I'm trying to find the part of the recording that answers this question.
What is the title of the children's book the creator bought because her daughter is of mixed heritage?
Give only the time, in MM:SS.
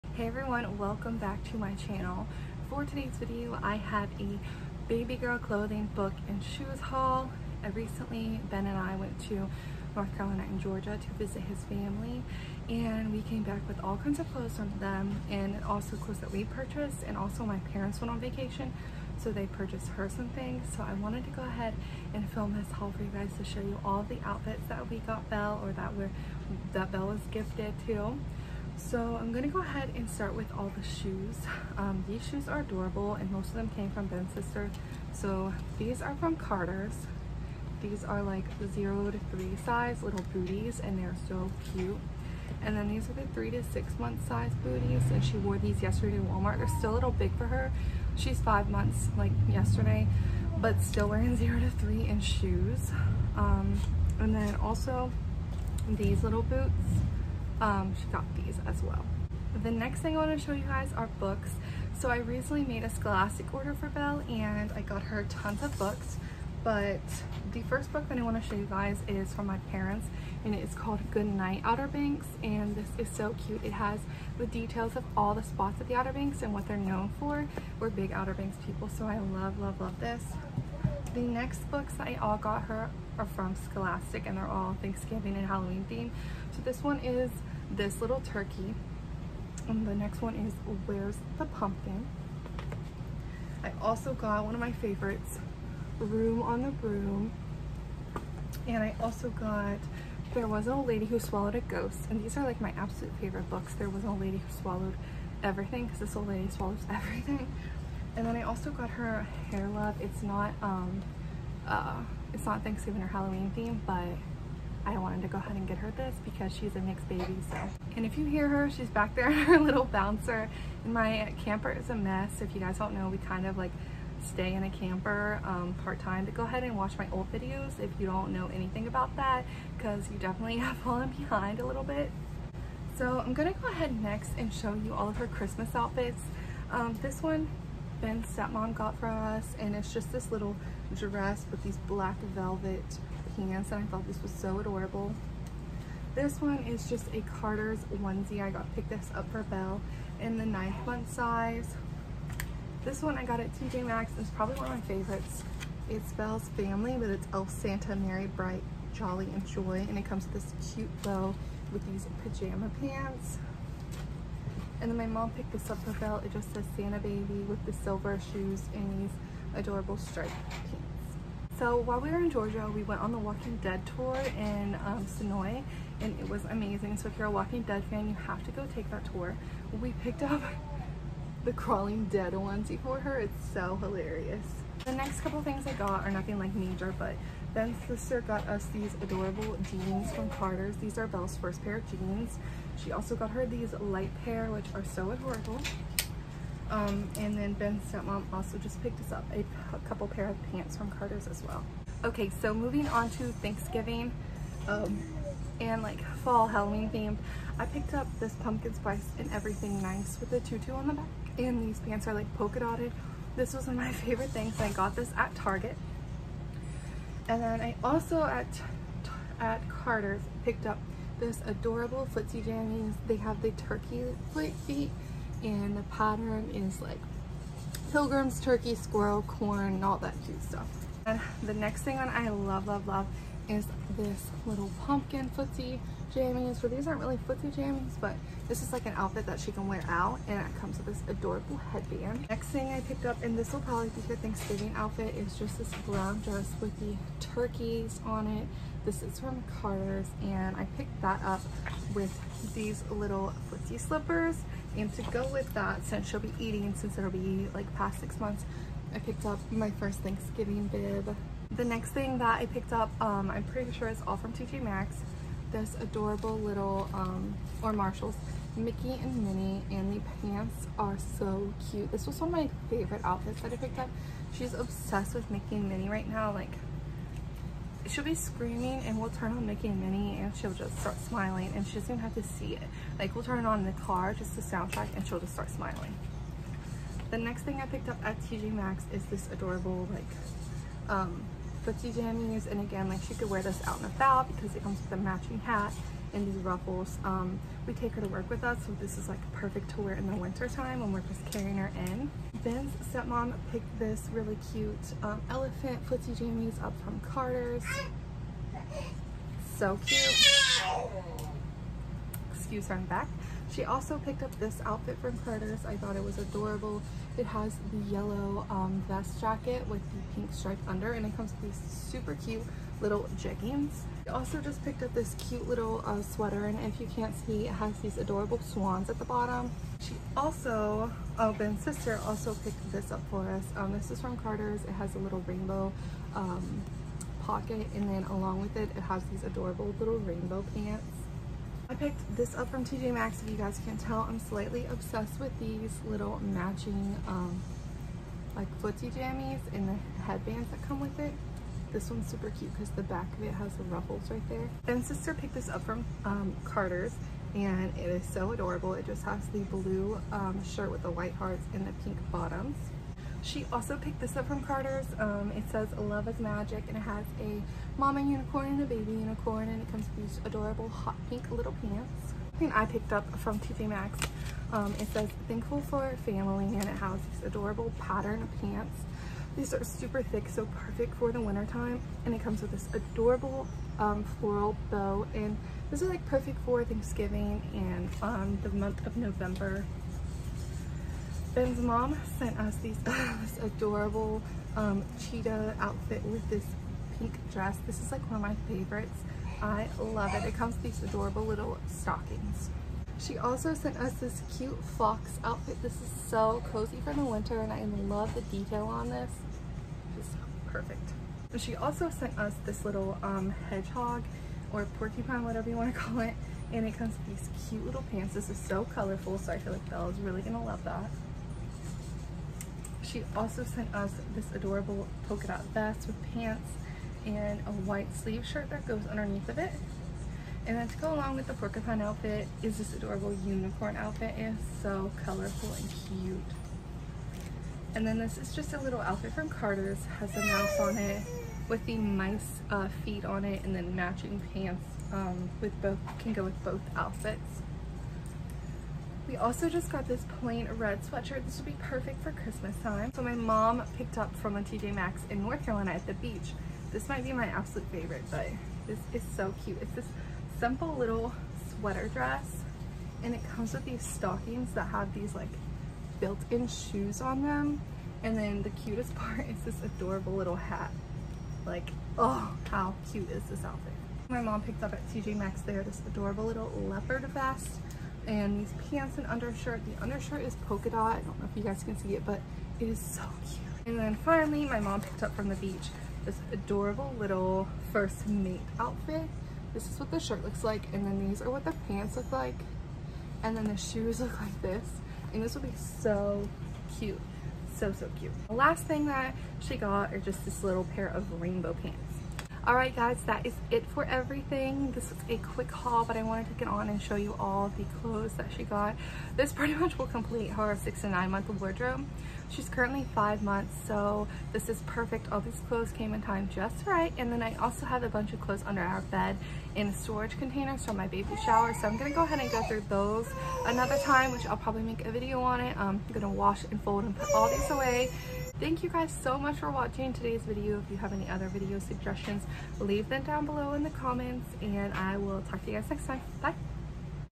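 01:49.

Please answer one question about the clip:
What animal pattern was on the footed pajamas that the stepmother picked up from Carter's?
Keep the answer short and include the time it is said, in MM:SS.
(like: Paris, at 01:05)
Elephant, at 05:05.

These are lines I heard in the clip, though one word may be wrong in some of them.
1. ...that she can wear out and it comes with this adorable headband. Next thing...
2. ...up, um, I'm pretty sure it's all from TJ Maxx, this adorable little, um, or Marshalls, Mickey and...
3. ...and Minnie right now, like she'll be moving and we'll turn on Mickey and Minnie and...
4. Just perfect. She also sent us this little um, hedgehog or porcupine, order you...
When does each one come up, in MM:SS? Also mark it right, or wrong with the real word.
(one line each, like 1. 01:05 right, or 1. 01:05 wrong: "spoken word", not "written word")
1. 03:59 right
2. 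04:22 right
3. 04:35 wrong: "screaming", not "moving"
4. 06:49 wrong: "whatever", not "order".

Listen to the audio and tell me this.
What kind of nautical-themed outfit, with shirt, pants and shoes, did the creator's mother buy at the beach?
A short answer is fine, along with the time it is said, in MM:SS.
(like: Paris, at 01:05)
First mate, at 08:07.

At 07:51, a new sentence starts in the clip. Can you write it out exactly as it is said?
Like, oh, how cute is this outfit?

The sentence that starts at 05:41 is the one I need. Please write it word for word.
I picked this up from TJ Maxx.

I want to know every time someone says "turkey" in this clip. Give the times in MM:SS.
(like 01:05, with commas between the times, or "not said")
01:28, 03:43, 03:48, 04:07.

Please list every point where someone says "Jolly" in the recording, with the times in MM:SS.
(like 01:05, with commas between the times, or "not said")
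02:38.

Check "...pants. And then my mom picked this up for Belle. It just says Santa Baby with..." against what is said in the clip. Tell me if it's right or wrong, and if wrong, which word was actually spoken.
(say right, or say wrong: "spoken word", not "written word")
right.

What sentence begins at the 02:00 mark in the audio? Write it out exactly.
And my camper is a mess.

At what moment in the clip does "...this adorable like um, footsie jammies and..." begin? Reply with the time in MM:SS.
04:49.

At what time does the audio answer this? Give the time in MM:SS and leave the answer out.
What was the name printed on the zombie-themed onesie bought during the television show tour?
03:01.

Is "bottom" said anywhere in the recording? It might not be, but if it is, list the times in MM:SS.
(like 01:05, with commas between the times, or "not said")
05:29, 06:02.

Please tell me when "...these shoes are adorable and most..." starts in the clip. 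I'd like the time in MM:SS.
00:32.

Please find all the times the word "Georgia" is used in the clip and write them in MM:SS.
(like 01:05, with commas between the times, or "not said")
00:10, 02:52.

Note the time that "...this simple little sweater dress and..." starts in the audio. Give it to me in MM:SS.
07:39.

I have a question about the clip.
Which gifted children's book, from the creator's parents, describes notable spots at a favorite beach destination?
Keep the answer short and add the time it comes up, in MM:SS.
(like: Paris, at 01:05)
Good Night Outer Banks, at 01:11.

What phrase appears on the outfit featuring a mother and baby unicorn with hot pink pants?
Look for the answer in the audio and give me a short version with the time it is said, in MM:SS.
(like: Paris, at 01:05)
Love is Magic, at 06:05.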